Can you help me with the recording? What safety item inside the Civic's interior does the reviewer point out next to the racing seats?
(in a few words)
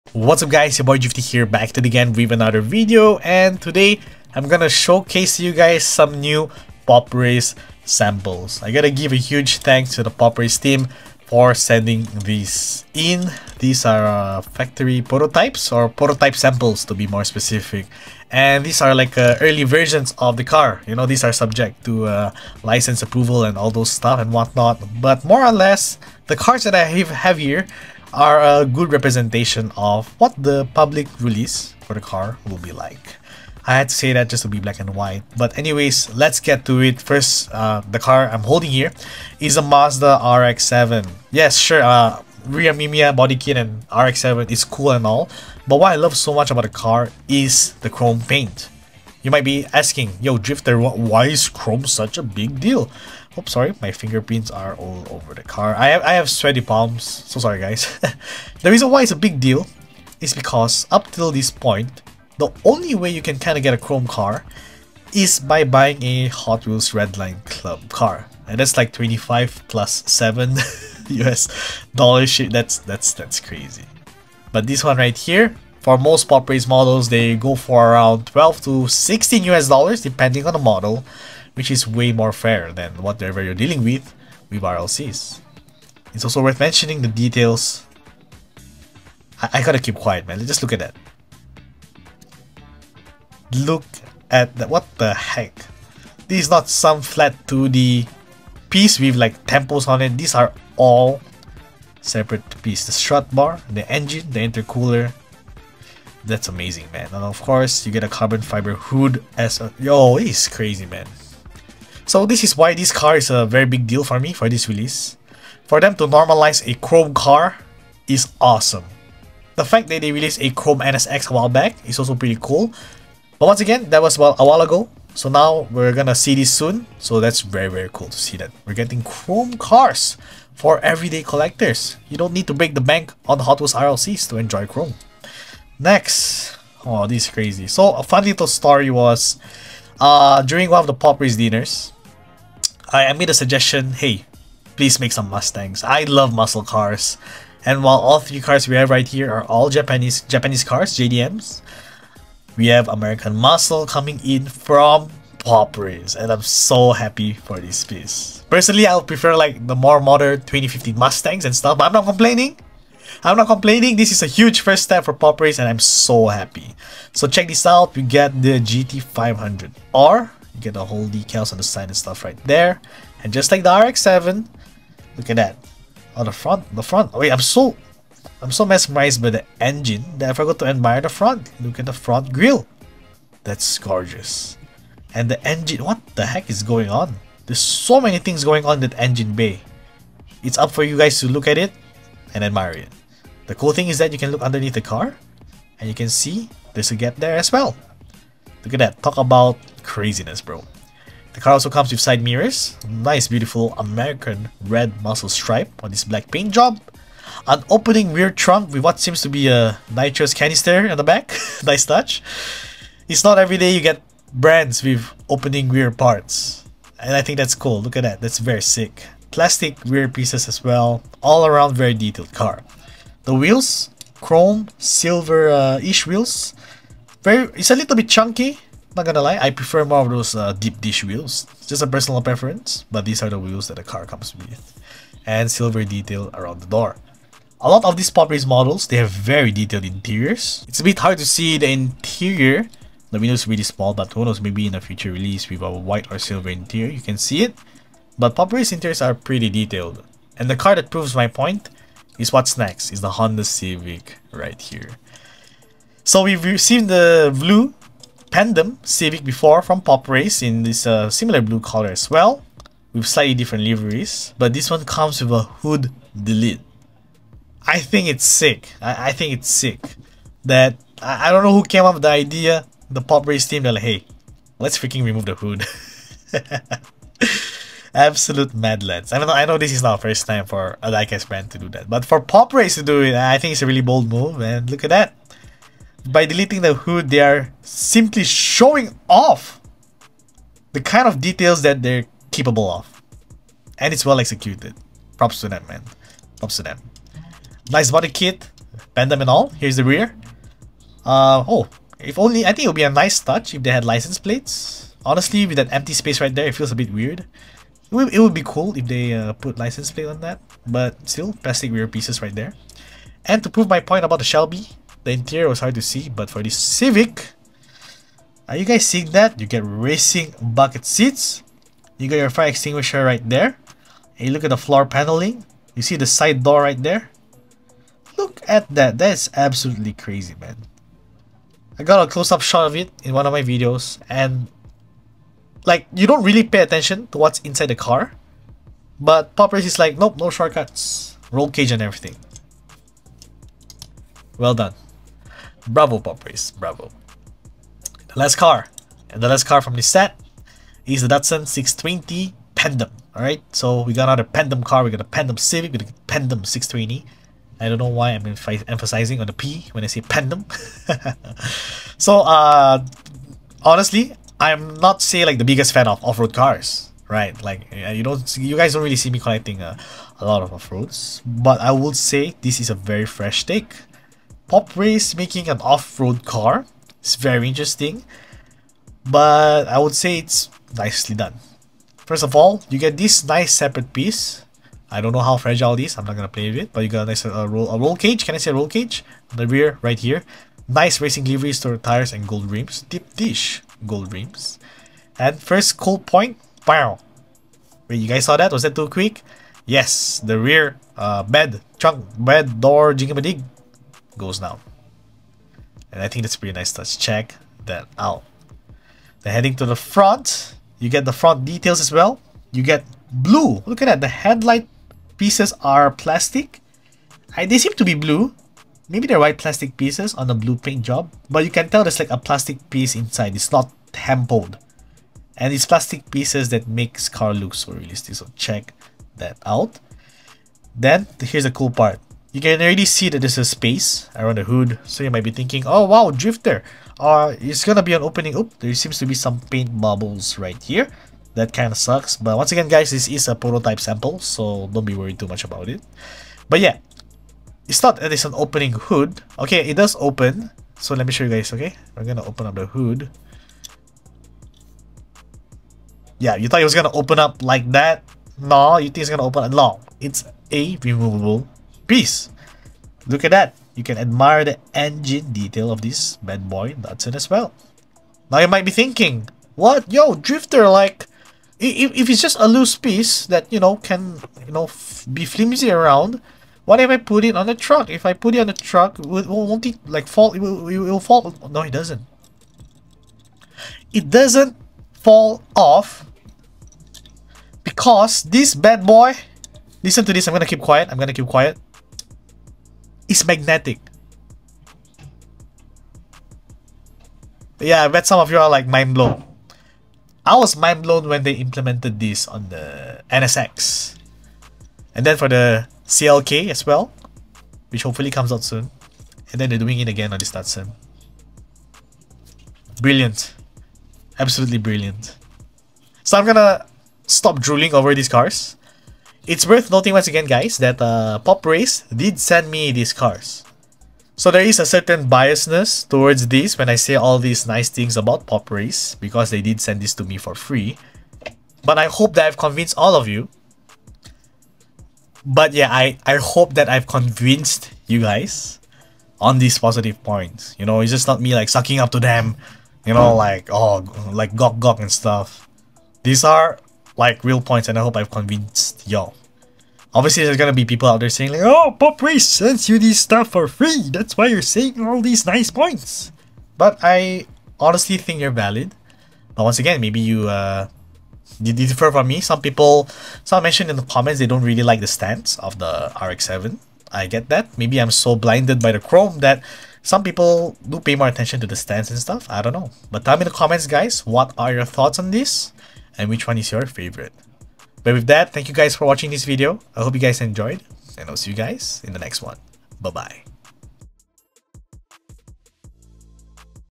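fire extinguisher.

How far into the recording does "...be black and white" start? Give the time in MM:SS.
00:34.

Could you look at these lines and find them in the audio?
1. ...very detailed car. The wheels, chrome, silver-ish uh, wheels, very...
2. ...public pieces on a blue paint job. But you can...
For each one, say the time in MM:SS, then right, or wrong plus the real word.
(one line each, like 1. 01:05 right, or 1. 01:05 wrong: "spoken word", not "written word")
1. 03:41 right
2. 06:59 wrong: "plastic", not "public".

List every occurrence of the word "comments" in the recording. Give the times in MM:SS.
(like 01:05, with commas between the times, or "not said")
09:23, 09:33.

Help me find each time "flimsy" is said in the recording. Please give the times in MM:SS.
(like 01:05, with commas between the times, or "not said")
07:55.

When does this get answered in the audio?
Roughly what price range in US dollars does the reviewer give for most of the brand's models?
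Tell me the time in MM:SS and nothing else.
01:18.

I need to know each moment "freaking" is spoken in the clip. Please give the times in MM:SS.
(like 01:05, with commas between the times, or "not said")
04:34.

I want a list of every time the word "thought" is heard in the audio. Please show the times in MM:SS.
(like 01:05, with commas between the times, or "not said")
07:36, 09:34.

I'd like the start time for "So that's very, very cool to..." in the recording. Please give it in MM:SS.
02:06.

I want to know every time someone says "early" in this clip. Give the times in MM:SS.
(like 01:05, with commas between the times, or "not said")
00:19.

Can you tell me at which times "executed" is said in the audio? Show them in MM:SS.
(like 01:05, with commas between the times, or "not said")
04:54.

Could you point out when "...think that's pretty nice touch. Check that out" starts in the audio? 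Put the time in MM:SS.
06:46.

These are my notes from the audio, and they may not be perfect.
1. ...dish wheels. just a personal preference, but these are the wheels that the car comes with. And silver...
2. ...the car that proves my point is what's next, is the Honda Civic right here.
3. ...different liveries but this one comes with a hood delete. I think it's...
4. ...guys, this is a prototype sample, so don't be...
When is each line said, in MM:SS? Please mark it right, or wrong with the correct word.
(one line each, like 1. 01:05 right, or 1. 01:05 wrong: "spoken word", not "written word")
1. 03:50 right
2. 04:10 right
3. 04:23 right
4. 07:22 right.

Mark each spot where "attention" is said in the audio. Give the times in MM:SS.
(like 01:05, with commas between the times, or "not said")
05:36, 09:31.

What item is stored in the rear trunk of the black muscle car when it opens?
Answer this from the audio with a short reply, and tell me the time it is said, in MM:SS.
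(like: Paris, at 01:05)
nitrous canister, at 03:29.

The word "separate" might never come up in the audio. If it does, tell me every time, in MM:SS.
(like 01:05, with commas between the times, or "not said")
01:42, 06:23.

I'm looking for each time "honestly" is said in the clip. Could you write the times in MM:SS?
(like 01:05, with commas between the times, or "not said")
05:05, 06:03, 09:17.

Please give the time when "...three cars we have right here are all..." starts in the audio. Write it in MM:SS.
02:28.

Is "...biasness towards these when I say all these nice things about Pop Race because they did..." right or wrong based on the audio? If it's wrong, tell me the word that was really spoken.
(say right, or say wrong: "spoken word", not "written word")
right.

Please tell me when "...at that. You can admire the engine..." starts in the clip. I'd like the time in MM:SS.
07:43.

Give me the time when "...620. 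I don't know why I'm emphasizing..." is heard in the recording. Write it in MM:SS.
05:56.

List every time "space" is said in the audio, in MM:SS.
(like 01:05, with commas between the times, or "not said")
05:05, 07:13.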